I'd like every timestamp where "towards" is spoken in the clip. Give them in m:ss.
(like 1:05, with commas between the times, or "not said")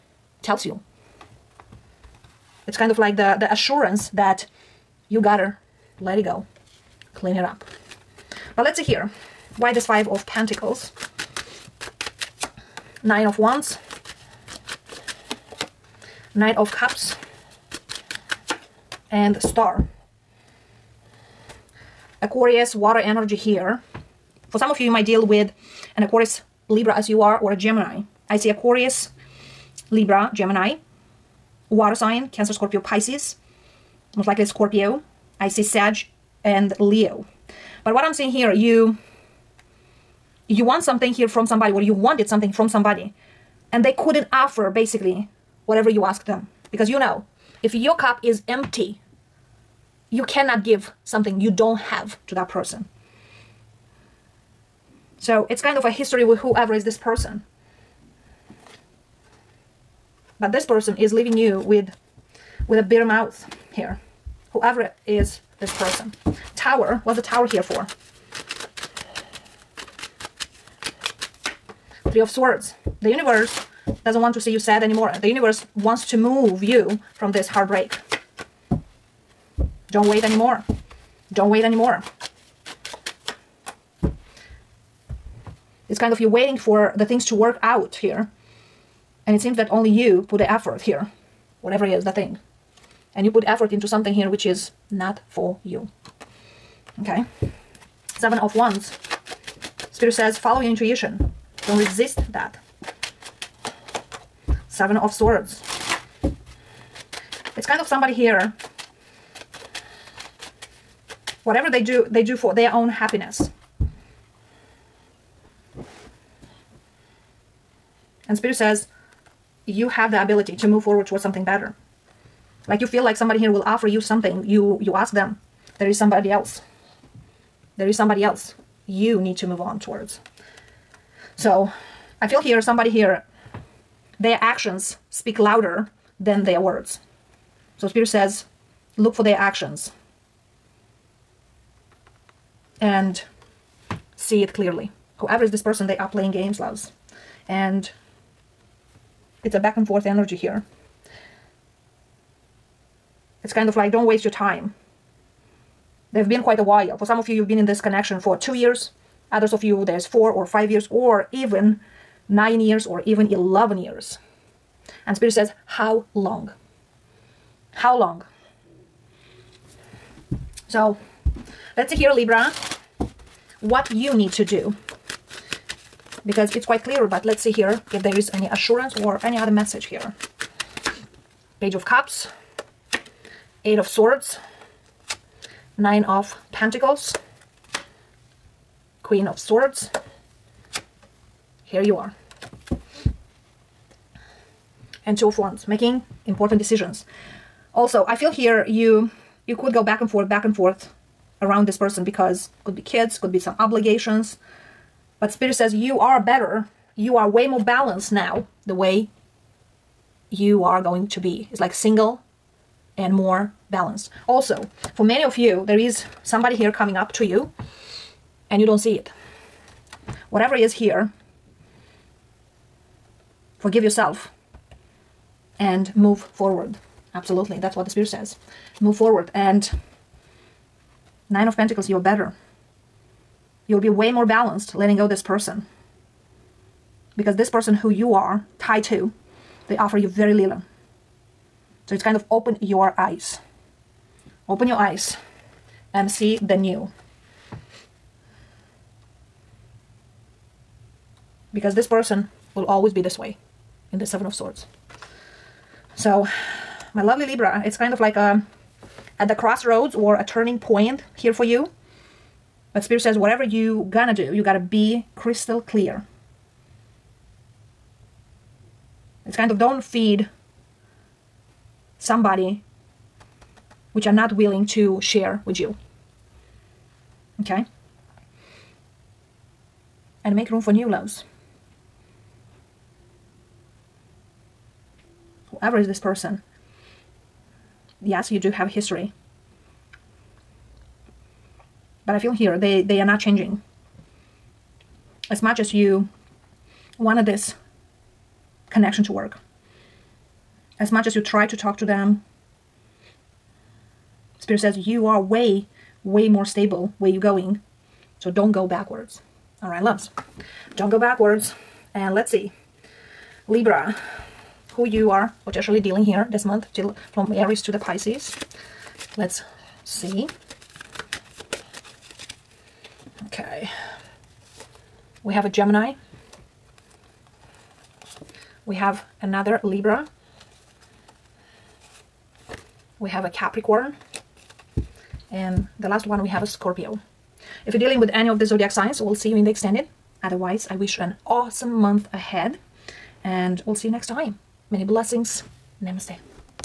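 2:01, 2:09.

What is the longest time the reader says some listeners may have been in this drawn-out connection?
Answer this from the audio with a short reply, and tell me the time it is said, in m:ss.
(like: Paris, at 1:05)
11 years, at 2:43.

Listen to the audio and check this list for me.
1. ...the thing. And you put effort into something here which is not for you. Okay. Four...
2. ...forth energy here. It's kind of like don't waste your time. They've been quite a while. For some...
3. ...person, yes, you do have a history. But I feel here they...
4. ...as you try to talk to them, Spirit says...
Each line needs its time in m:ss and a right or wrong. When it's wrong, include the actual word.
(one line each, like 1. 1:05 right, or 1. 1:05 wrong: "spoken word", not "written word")
1. 1:32 wrong: "Seven", not "Four"
2. 2:29 right
3. 4:45 right
4. 5:01 right.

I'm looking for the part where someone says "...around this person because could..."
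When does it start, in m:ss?
3:21.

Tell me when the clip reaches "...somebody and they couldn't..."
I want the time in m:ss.
0:42.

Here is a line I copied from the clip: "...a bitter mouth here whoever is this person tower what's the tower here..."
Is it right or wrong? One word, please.
right.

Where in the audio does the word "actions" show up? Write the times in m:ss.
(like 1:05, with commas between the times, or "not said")
2:14, 2:19.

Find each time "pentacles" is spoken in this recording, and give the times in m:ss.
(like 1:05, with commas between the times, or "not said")
0:10, 3:06, 3:51.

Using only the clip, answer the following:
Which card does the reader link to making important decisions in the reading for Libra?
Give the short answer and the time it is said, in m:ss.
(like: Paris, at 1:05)
Two of Wands, at 3:15.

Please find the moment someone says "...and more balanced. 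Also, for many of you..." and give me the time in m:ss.
3:32.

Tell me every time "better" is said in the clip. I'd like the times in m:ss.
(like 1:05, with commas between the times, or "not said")
2:01, 3:26, 3:51.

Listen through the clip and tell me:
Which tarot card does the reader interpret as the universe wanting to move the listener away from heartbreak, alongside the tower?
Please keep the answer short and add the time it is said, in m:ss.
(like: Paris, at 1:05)
Three of Swords, at 1:12.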